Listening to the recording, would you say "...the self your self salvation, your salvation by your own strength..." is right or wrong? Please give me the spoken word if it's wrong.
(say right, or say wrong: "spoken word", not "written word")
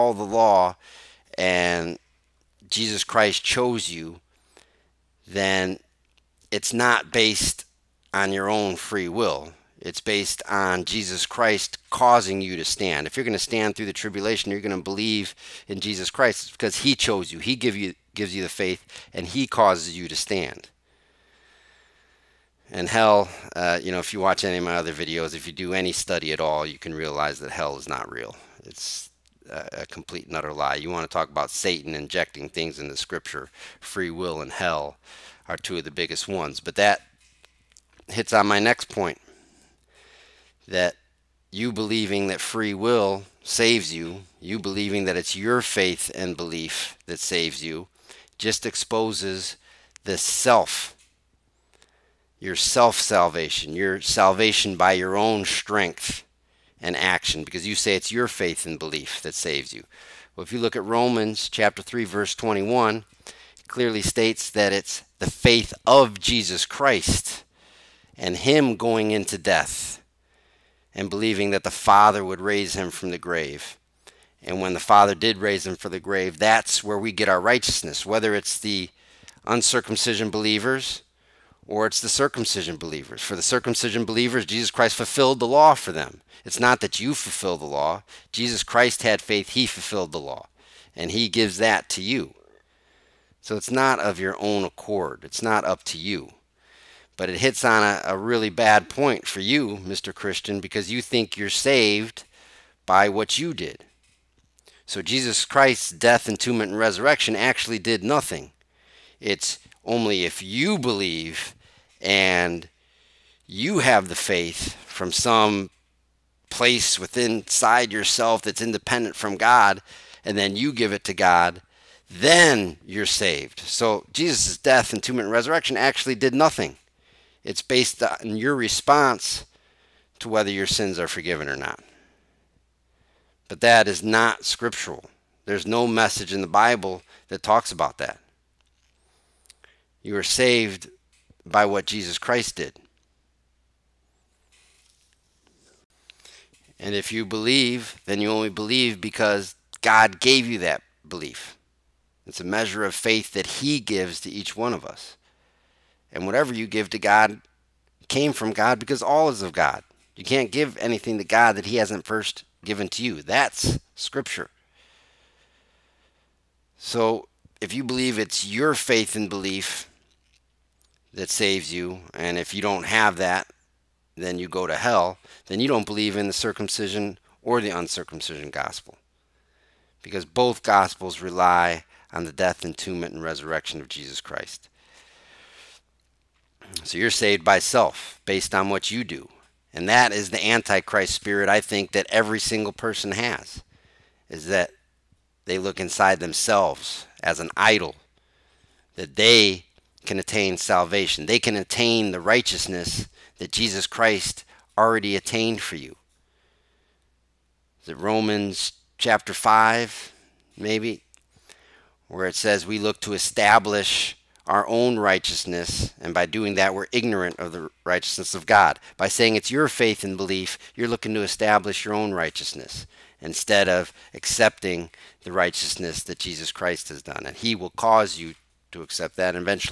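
right.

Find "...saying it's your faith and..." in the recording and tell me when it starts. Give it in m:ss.
3:39.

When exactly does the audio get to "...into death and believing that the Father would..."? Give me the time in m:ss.
1:09.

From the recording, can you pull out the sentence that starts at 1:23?
For the circumcision believers, Jesus Christ fulfilled the law for them.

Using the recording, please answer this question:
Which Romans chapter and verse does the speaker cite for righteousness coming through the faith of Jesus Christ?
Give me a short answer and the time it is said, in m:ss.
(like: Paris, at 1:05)
Romans 3:21, at 1:00.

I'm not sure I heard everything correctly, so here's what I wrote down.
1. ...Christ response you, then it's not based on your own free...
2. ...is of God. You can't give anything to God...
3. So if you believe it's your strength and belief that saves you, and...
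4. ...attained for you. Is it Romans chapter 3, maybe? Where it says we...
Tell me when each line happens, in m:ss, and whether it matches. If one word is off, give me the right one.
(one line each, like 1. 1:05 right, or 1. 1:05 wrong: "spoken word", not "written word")
1. 0:03 wrong: "chose", not "response"
2. 2:39 right
3. 2:46 wrong: "faith", not "strength"
4. 3:25 wrong: "5", not "3".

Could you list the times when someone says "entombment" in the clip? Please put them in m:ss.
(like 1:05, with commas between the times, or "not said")
1:46, 3:02.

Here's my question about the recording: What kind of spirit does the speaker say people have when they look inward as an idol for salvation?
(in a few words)
Antichrist spirit.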